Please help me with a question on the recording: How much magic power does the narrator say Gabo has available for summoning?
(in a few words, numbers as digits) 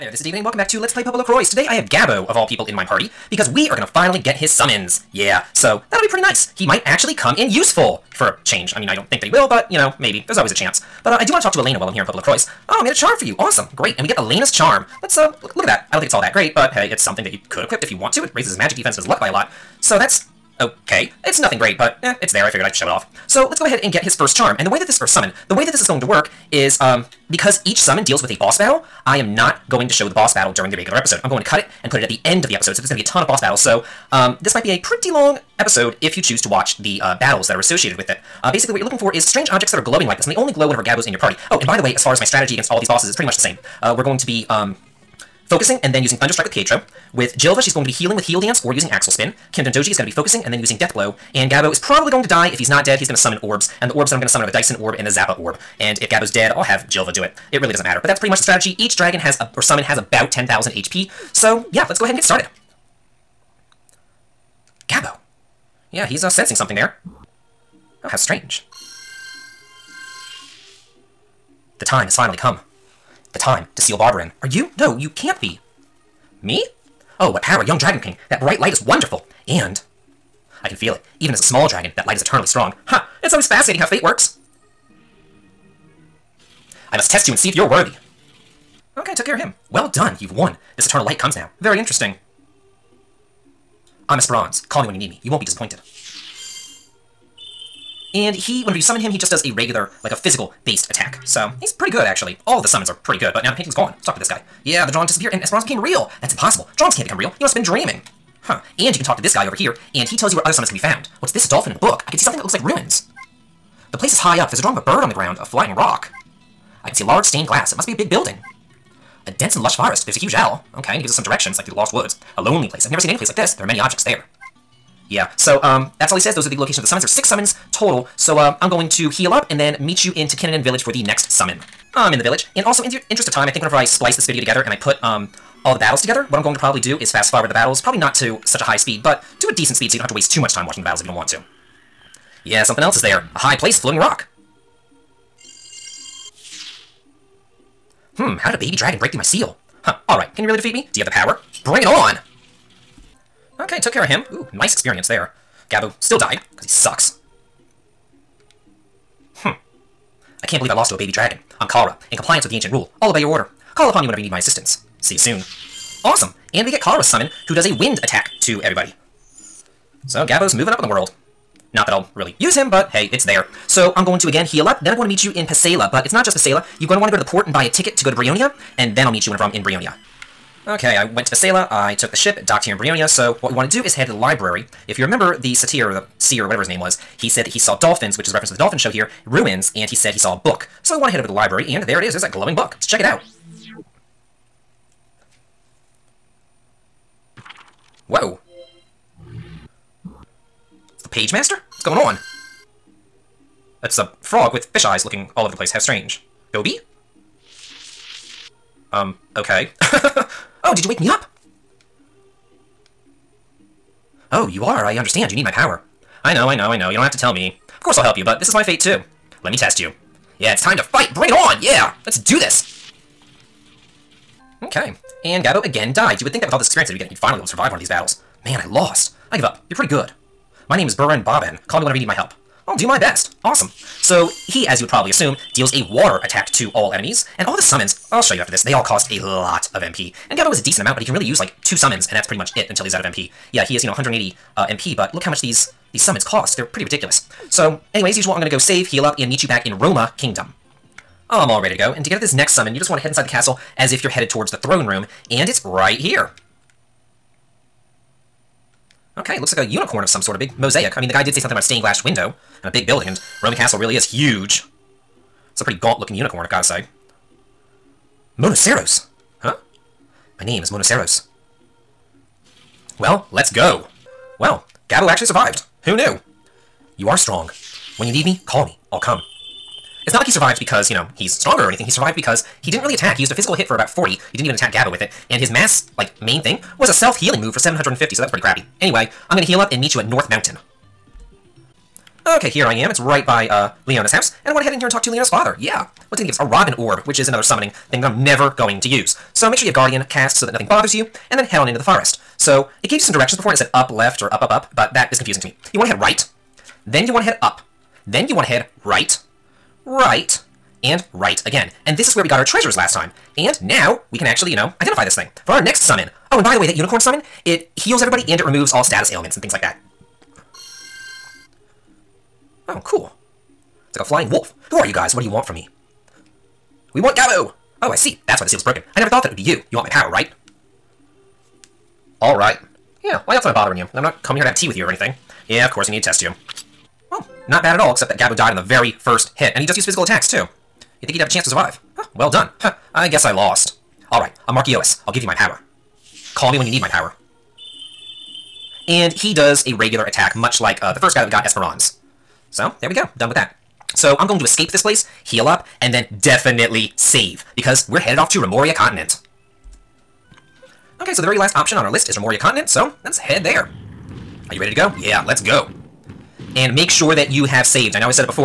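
180.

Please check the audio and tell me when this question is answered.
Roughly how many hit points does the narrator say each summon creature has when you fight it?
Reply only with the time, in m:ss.
1:00.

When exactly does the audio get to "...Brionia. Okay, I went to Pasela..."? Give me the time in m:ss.
2:59.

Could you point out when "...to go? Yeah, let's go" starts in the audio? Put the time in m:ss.
6:04.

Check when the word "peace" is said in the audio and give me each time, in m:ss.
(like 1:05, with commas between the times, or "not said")
not said.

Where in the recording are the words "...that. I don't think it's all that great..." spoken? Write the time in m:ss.
0:15.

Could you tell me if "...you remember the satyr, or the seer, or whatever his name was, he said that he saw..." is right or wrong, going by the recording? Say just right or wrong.
right.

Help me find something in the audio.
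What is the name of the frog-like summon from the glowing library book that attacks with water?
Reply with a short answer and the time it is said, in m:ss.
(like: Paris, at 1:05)
Burin Bobbin, at 3:50.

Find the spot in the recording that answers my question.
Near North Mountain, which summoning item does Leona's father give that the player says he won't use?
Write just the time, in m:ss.
4:56.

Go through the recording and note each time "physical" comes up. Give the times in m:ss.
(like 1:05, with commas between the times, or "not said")
1:40, 4:43, 5:39.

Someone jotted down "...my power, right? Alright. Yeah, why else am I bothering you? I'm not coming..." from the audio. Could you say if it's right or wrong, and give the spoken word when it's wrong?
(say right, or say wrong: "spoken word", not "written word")
right.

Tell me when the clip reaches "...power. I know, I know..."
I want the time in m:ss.
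3:35.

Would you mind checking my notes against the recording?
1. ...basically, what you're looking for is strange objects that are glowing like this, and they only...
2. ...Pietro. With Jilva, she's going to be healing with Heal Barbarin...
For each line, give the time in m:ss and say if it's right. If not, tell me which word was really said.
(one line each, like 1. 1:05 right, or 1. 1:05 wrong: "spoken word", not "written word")
1. 0:38 right
2. 0:46 wrong: "Dance", not "Barbarin".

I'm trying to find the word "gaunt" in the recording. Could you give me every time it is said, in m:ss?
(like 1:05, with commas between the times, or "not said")
4:25.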